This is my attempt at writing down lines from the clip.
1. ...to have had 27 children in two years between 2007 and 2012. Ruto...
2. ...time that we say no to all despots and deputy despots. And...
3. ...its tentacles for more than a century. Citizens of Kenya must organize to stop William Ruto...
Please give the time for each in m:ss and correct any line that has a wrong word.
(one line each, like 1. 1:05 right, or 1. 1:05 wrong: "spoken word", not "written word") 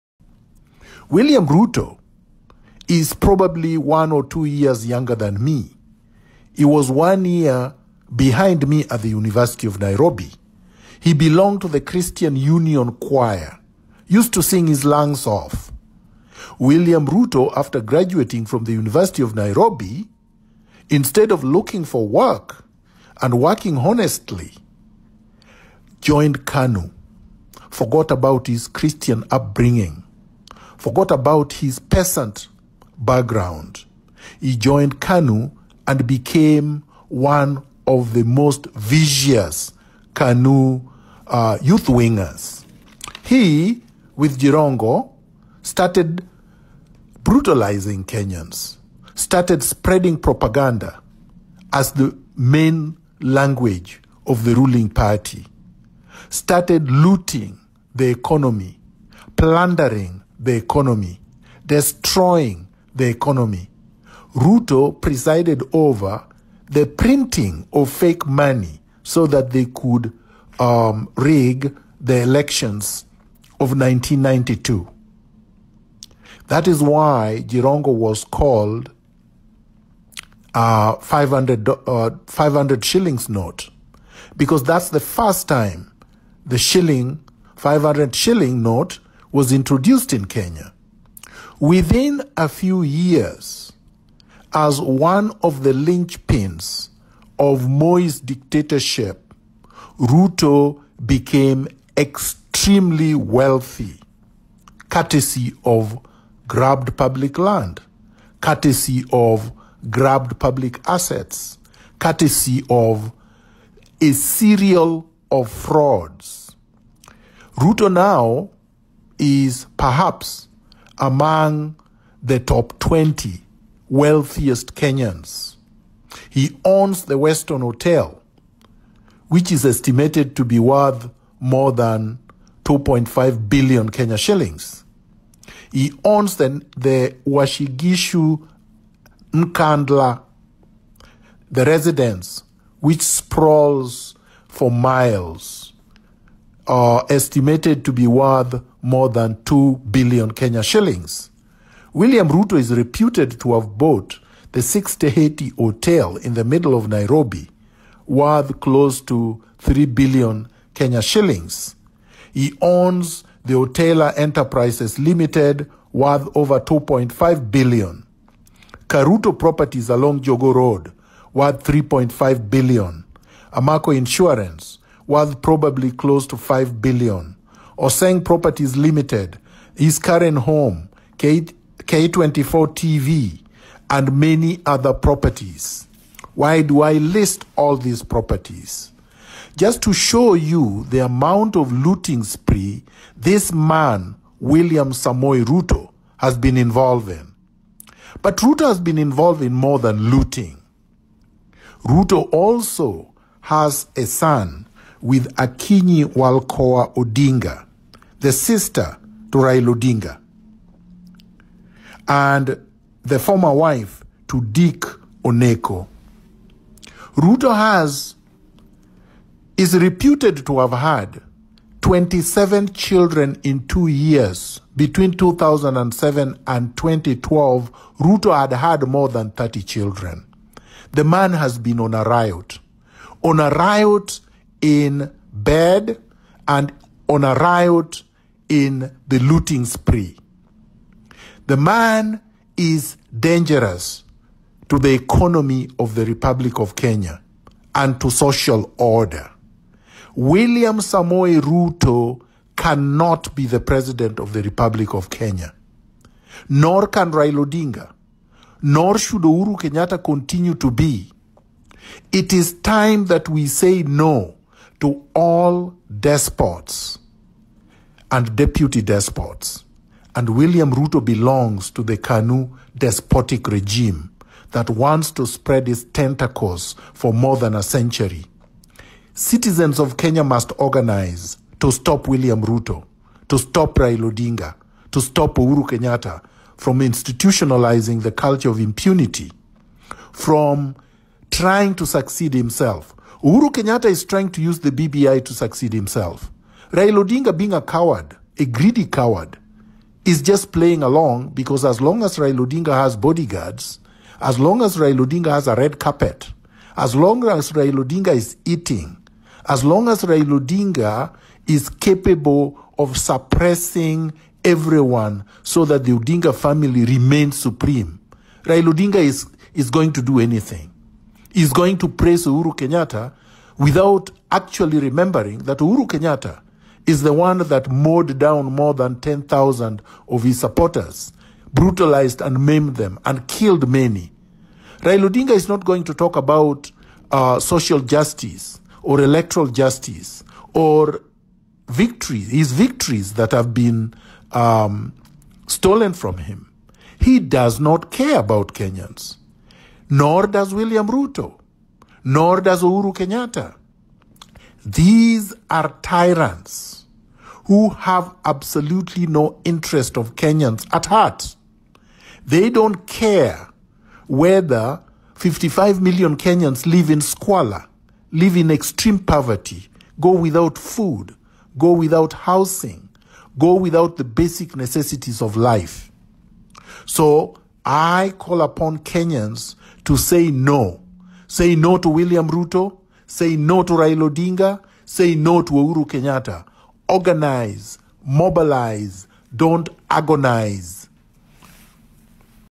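1. 3:40 right
2. 4:22 right
3. 4:35 right.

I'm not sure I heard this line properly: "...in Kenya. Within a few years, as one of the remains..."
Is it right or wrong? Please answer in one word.
wrong.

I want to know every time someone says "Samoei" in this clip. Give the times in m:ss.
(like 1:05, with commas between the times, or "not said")
3:14, 4:10.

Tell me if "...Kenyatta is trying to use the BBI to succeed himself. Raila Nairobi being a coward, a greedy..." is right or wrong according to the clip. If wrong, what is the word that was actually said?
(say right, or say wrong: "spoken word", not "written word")
wrong: "Odinga", not "Nairobi".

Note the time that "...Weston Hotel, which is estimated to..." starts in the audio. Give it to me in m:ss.
2:07.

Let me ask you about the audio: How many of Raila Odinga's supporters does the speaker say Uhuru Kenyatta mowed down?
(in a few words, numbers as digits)
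More than 10,000.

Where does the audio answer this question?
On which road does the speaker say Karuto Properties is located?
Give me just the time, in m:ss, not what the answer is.
2:50.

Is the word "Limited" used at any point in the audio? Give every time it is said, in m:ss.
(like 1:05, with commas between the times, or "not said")
2:44, 2:58.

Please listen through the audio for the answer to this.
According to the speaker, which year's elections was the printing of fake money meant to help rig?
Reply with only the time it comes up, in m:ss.
1:13.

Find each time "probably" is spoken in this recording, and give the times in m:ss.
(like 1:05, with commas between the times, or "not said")
0:03, 2:55.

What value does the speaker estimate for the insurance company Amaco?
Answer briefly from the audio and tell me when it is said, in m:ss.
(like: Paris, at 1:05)
5 billion Kenya shillings, at 2:56.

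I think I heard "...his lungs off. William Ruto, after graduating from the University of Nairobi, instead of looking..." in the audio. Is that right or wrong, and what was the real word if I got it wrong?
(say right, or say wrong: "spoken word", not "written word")
right.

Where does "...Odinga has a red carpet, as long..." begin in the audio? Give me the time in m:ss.
5:05.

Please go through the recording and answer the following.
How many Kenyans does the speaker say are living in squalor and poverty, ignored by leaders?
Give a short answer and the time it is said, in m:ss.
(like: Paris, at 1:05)
55 million, at 6:05.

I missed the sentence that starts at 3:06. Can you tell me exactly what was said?
Why do I list all these properties?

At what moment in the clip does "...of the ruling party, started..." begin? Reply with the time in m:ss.
0:54.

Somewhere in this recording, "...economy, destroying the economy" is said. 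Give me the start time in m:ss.
1:00.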